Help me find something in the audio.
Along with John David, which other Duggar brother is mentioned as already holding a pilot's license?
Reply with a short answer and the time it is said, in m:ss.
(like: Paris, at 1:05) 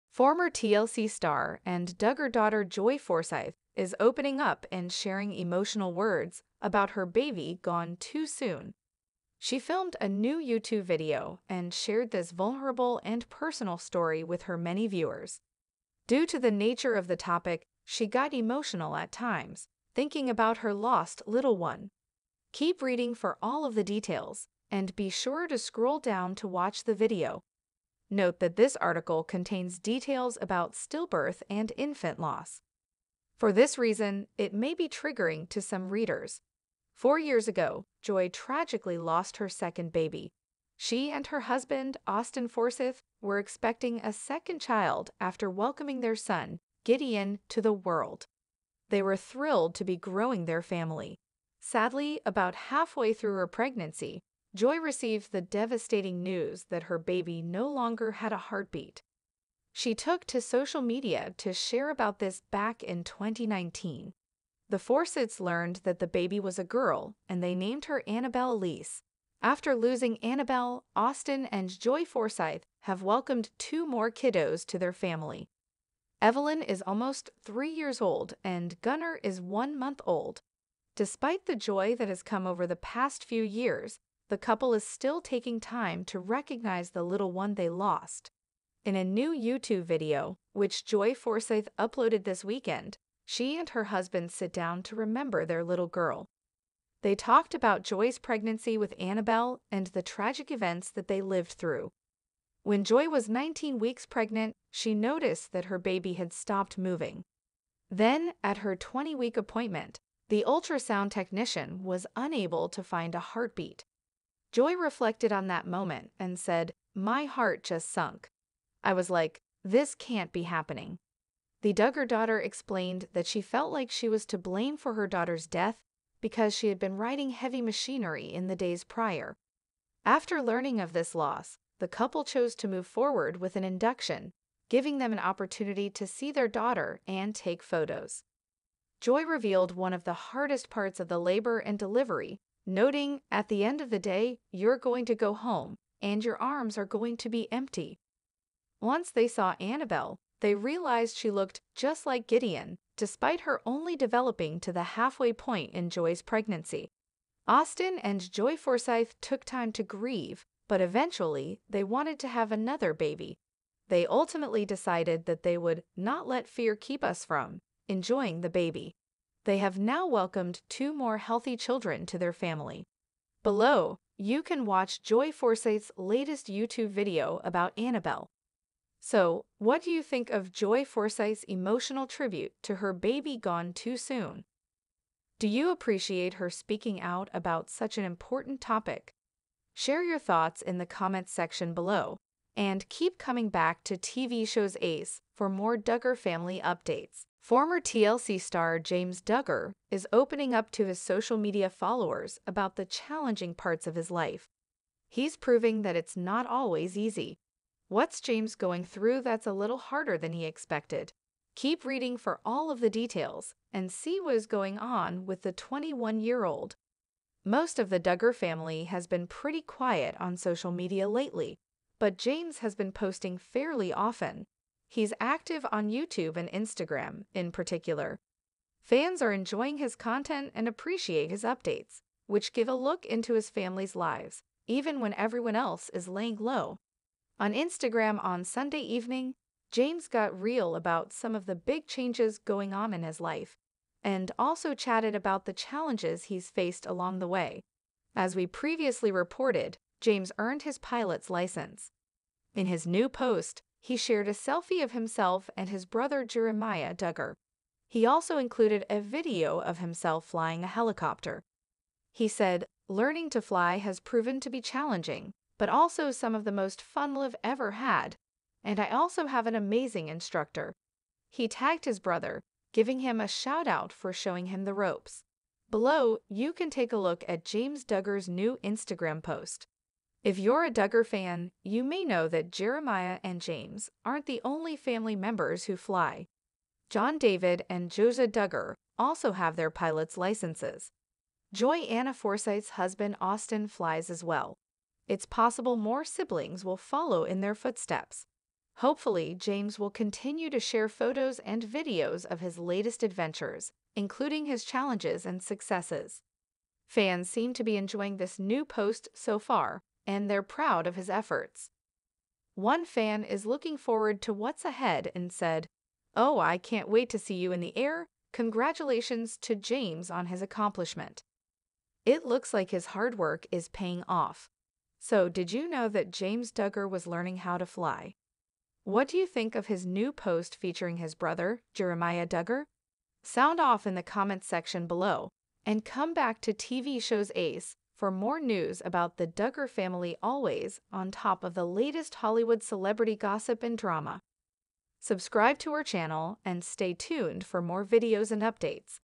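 Josiah, at 4:47.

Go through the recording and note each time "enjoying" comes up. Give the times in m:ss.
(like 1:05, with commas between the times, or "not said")
2:47, 3:49, 5:07.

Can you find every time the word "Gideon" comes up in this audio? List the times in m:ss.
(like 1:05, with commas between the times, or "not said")
0:46, 2:32.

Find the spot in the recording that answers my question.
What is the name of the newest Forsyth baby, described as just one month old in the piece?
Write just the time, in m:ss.
1:18.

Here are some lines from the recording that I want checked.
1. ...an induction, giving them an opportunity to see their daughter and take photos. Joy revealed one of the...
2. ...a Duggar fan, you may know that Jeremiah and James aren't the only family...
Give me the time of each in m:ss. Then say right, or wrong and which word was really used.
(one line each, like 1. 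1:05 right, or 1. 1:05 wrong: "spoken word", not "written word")
1. 2:13 right
2. 4:40 right.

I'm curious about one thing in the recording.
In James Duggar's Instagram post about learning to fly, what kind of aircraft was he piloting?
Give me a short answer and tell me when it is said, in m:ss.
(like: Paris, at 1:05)
helicopter, at 4:20.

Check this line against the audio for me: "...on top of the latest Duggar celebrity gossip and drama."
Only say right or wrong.
wrong.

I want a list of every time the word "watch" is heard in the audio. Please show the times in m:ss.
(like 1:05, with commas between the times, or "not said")
0:26, 2:54.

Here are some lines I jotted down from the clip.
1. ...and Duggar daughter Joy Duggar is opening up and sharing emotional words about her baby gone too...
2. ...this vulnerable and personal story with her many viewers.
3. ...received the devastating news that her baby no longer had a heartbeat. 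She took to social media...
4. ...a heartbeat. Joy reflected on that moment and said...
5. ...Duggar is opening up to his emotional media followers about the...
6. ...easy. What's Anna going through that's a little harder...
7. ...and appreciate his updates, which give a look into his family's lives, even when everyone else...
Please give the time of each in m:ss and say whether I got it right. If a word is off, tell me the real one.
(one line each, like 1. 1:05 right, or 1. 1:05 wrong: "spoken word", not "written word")
1. 0:01 wrong: "Forsyth", not "Duggar"
2. 0:12 right
3. 0:54 right
4. 1:53 right
5. 3:19 wrong: "social", not "emotional"
6. 3:26 wrong: "James", not "Anna"
7. 3:50 right.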